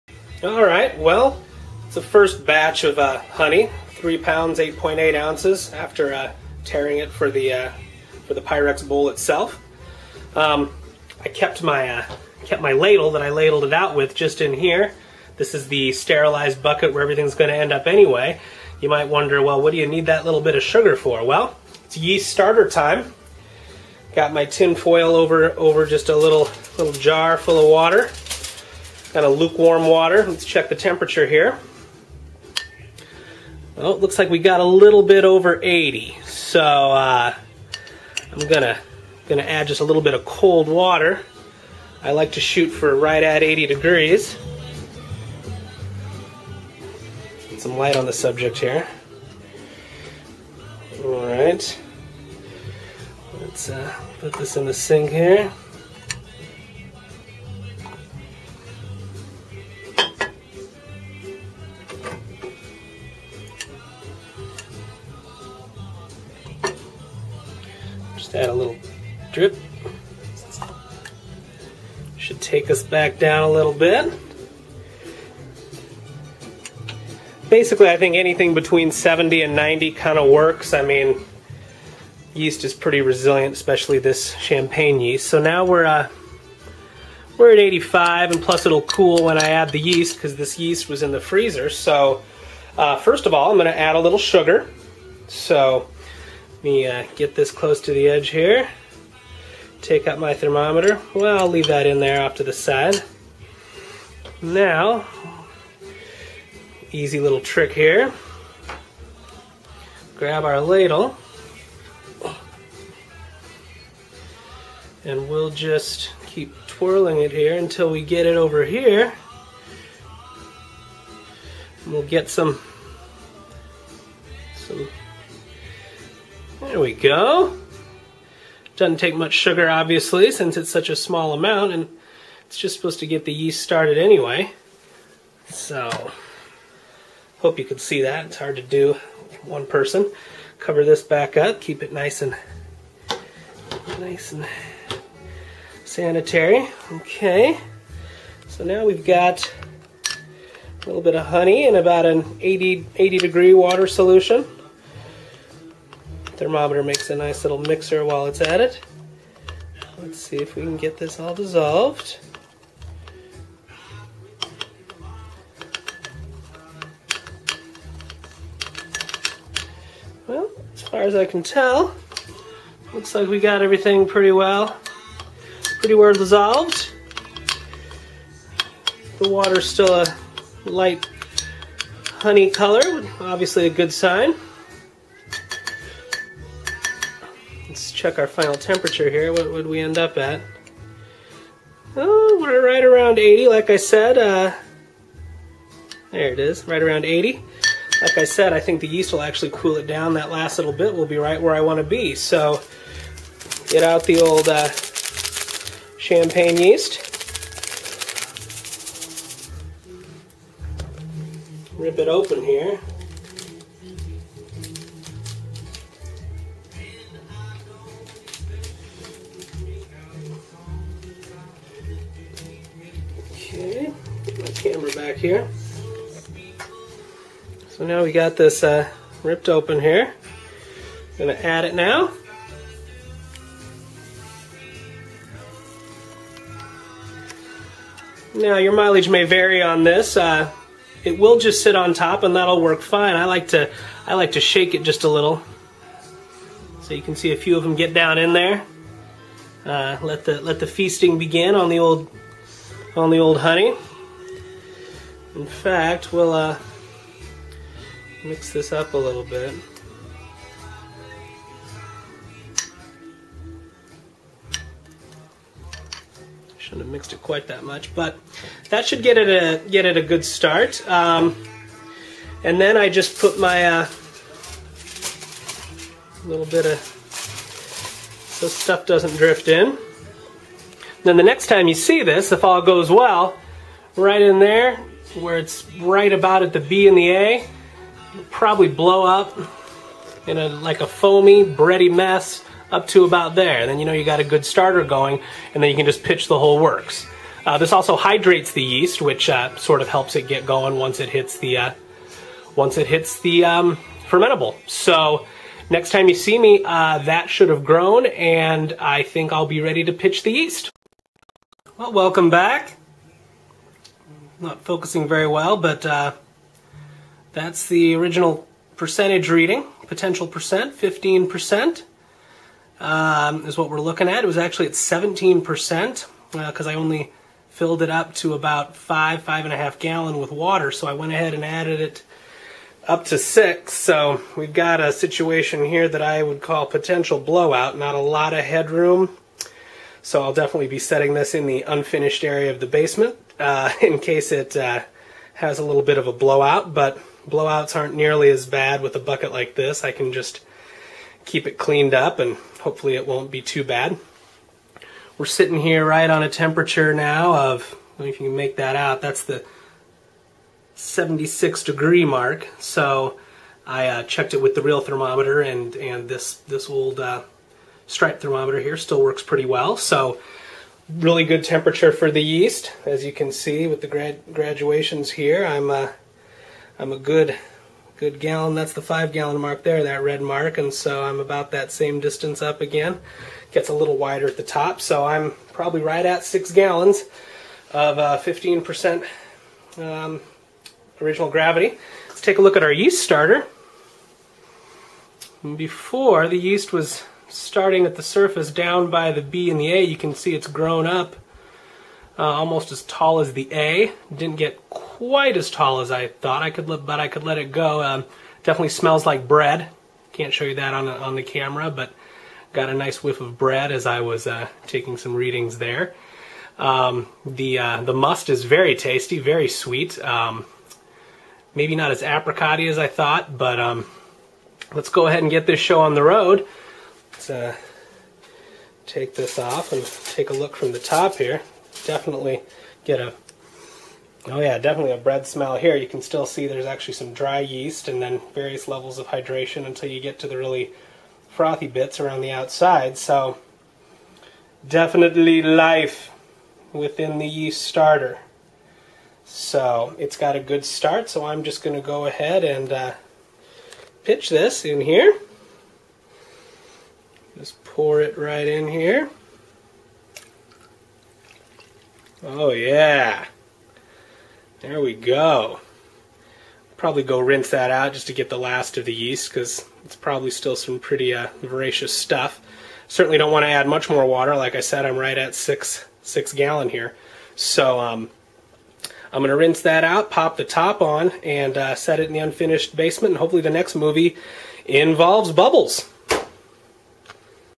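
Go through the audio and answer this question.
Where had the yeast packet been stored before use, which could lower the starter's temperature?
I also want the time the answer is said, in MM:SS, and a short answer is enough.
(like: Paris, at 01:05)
The freezer, at 01:31.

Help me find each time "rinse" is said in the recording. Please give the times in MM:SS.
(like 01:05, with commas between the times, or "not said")
07:47, 07:59.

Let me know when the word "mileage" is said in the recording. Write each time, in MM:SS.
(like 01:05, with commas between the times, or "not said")
03:58.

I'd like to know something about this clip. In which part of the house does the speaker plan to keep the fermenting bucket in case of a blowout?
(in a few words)
Unfinished area of the basement.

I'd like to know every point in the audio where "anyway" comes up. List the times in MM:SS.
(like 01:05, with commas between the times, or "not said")
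00:17, 02:13.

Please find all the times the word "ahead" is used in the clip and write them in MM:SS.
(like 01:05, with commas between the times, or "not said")
05:31, 07:05, 07:32.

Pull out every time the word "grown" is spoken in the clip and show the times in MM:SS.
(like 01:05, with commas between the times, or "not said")
05:07, 06:40.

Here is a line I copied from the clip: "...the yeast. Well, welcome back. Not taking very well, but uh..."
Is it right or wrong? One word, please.
wrong.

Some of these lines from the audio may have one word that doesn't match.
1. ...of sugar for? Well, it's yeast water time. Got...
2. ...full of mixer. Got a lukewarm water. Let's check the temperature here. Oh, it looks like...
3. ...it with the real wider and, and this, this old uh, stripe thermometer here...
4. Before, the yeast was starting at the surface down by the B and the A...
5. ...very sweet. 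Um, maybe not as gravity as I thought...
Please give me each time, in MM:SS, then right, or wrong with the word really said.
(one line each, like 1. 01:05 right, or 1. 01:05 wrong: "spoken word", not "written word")
1. 00:20 wrong: "starter", not "water"
2. 00:27 wrong: "water", not "mixer"
3. 06:04 wrong: "thermometer", not "wider"
4. 06:35 right
5. 06:59 wrong: "apricotty", not "gravity".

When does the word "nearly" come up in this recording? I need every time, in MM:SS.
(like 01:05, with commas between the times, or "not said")
05:47.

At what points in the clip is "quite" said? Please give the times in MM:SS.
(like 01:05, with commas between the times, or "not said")
04:27, 06:44.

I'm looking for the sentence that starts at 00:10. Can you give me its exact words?
Um, I kept my, uh, kept my ladle that I ladled it out with just in here.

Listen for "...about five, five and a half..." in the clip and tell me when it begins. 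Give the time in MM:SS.
05:28.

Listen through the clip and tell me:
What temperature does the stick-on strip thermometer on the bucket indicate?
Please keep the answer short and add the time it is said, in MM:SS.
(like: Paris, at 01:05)
76 degrees, at 06:00.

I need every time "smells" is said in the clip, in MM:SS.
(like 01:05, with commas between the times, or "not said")
06:48, 07:15.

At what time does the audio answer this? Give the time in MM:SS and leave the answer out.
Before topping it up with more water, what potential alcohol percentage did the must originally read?
05:24.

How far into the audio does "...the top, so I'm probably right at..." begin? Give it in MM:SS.
06:24.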